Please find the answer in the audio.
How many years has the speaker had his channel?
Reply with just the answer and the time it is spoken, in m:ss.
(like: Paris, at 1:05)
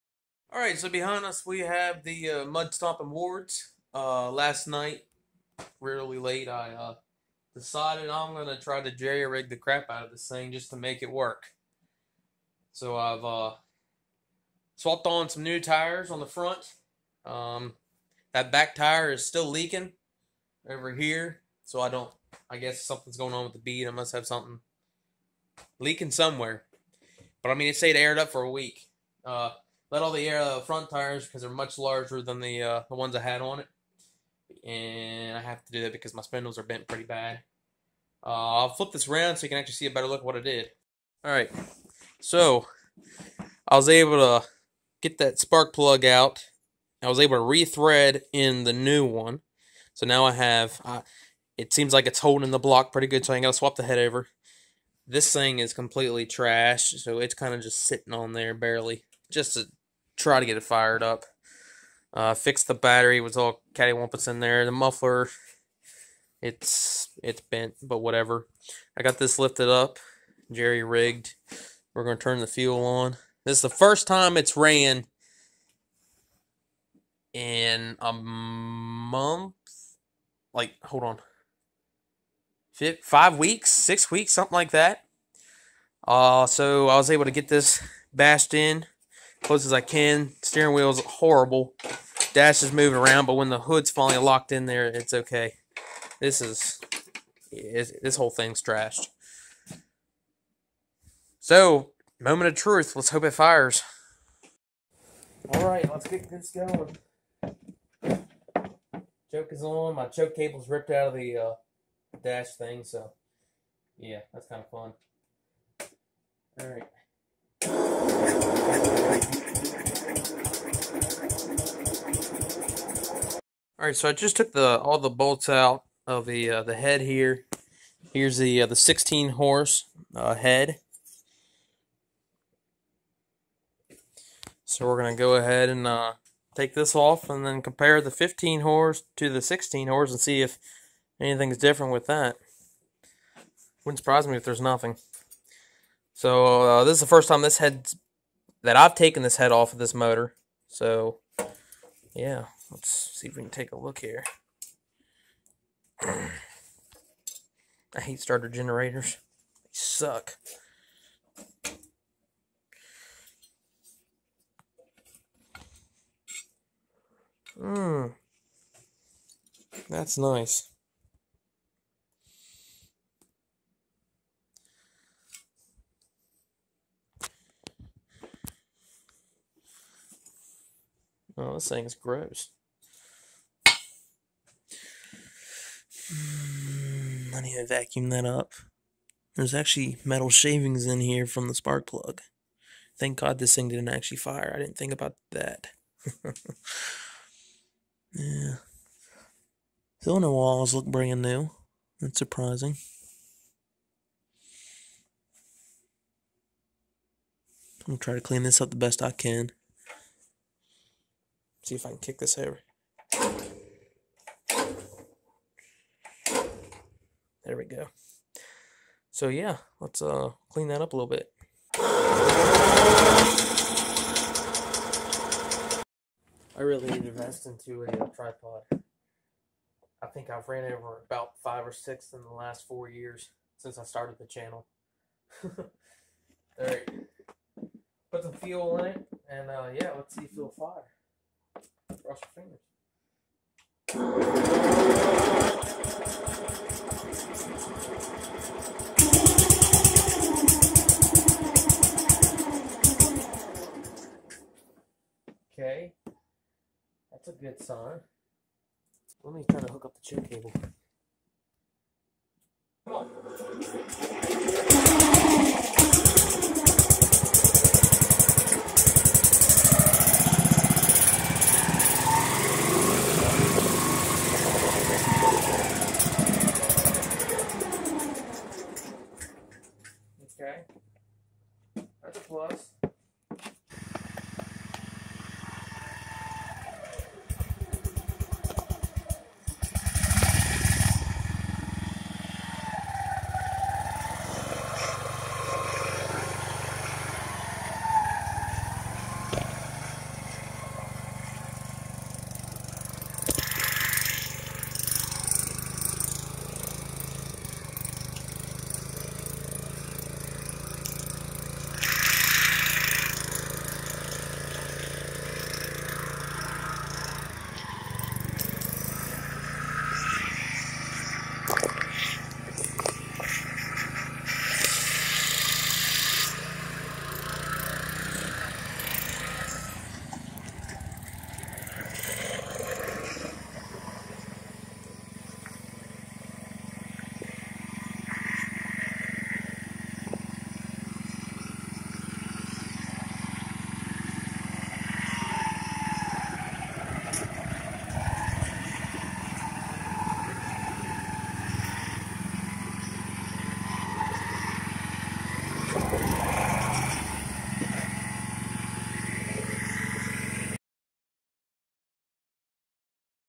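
4, at 3:52.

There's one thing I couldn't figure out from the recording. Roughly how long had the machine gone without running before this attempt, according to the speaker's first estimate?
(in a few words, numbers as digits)
a month.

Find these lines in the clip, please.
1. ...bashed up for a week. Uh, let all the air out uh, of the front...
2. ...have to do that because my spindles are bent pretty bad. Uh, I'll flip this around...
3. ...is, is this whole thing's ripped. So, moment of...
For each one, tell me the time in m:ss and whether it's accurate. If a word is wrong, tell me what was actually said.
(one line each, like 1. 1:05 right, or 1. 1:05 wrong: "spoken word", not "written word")
1. 0:27 wrong: "aired", not "bashed"
2. 0:35 right
3. 1:36 wrong: "trashed", not "ripped".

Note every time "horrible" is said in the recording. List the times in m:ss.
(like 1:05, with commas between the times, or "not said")
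1:31.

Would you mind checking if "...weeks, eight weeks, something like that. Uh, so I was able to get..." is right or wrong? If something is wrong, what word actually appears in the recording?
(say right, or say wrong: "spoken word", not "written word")
wrong: "six", not "eight".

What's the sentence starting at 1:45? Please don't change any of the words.
All right, let's get this going.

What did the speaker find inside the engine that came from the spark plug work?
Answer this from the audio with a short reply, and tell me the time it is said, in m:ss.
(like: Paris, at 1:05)
metal shavings, at 3:10.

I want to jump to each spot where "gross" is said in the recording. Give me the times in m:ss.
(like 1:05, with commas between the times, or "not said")
3:01.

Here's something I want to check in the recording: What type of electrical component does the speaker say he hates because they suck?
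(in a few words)
starter generators.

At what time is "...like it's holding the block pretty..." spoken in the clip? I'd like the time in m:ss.
0:51.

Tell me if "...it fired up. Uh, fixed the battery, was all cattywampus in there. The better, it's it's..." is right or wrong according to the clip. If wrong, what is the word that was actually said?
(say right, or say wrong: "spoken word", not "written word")
wrong: "muffler", not "better".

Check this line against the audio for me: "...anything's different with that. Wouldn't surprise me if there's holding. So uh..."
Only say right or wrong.
wrong.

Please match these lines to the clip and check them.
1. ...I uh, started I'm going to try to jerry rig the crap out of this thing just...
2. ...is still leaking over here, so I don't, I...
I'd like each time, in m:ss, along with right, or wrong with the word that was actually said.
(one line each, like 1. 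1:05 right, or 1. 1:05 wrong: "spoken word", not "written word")
1. 0:06 wrong: "decided", not "started"
2. 0:19 right.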